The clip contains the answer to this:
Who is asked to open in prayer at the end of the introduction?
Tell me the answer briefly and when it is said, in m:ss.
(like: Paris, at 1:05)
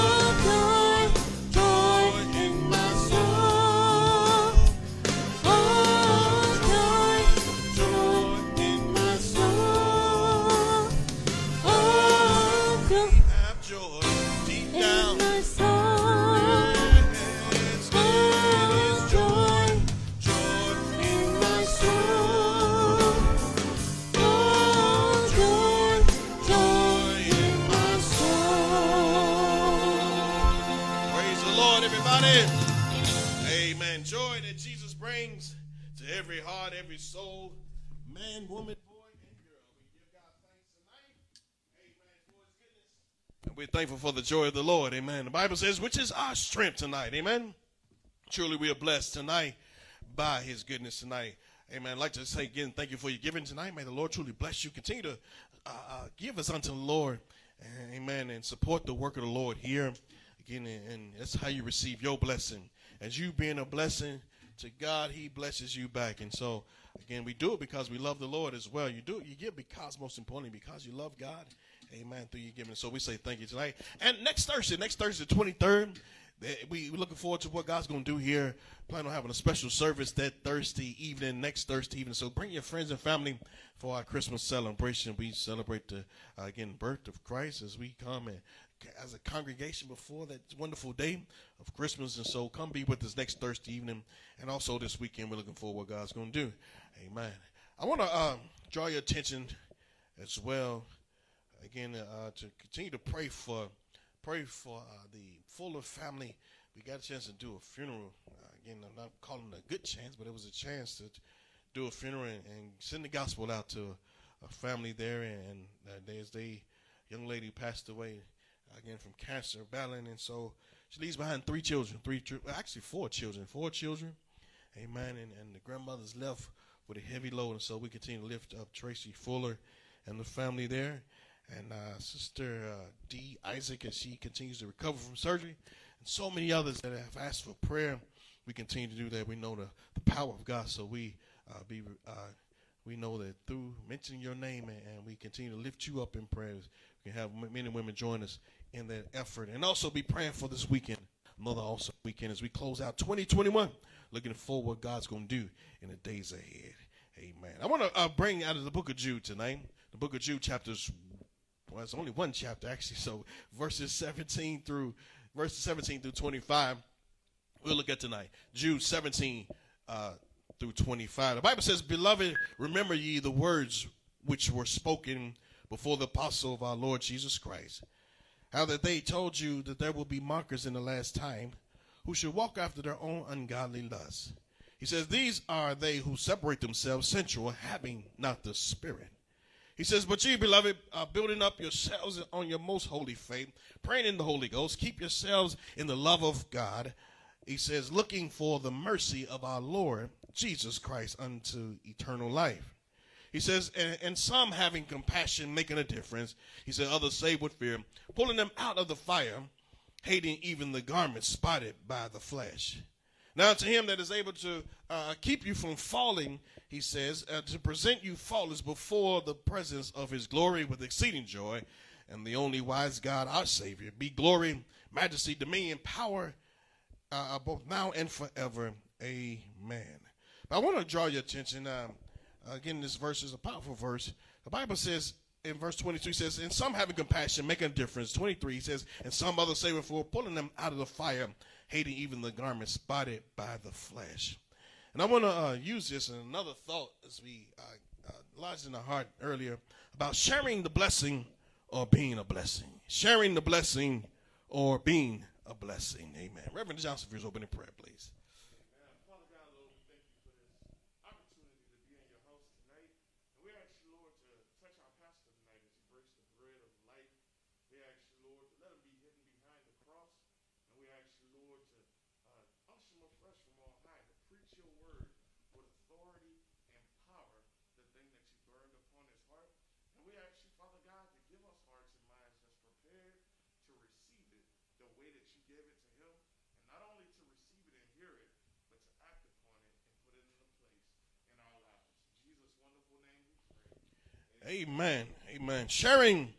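Reverend Johnson, at 4:16.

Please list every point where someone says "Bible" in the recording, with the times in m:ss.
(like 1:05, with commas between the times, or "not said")
0:45, 2:51, 3:54.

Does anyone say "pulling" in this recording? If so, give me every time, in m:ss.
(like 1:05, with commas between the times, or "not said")
3:28, 4:00.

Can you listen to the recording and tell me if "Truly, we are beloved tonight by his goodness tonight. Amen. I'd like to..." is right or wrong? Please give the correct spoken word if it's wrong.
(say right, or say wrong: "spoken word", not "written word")
wrong: "blessed", not "beloved".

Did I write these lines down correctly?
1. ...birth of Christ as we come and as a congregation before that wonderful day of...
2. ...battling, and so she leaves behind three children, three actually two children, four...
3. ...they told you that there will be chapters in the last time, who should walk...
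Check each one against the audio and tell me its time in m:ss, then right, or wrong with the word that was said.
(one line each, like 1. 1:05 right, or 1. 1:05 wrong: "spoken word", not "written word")
1. 1:26 right
2. 1:59 wrong: "four", not "two"
3. 2:58 wrong: "mockers", not "chapters".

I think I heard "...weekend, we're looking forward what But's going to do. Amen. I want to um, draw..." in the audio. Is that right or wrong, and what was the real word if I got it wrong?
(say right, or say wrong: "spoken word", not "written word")
wrong: "God", not "But".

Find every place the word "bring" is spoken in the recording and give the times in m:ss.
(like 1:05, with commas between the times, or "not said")
1:22, 2:38.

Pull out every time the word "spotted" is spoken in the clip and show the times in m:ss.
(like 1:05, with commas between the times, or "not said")
3:31, 4:02.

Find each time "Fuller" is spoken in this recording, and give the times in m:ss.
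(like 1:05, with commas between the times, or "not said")
1:45, 2:09.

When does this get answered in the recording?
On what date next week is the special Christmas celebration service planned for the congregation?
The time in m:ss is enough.
1:15.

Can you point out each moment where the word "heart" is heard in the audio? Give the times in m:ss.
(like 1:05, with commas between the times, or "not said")
4:08.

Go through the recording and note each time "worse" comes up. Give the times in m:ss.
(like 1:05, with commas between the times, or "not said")
not said.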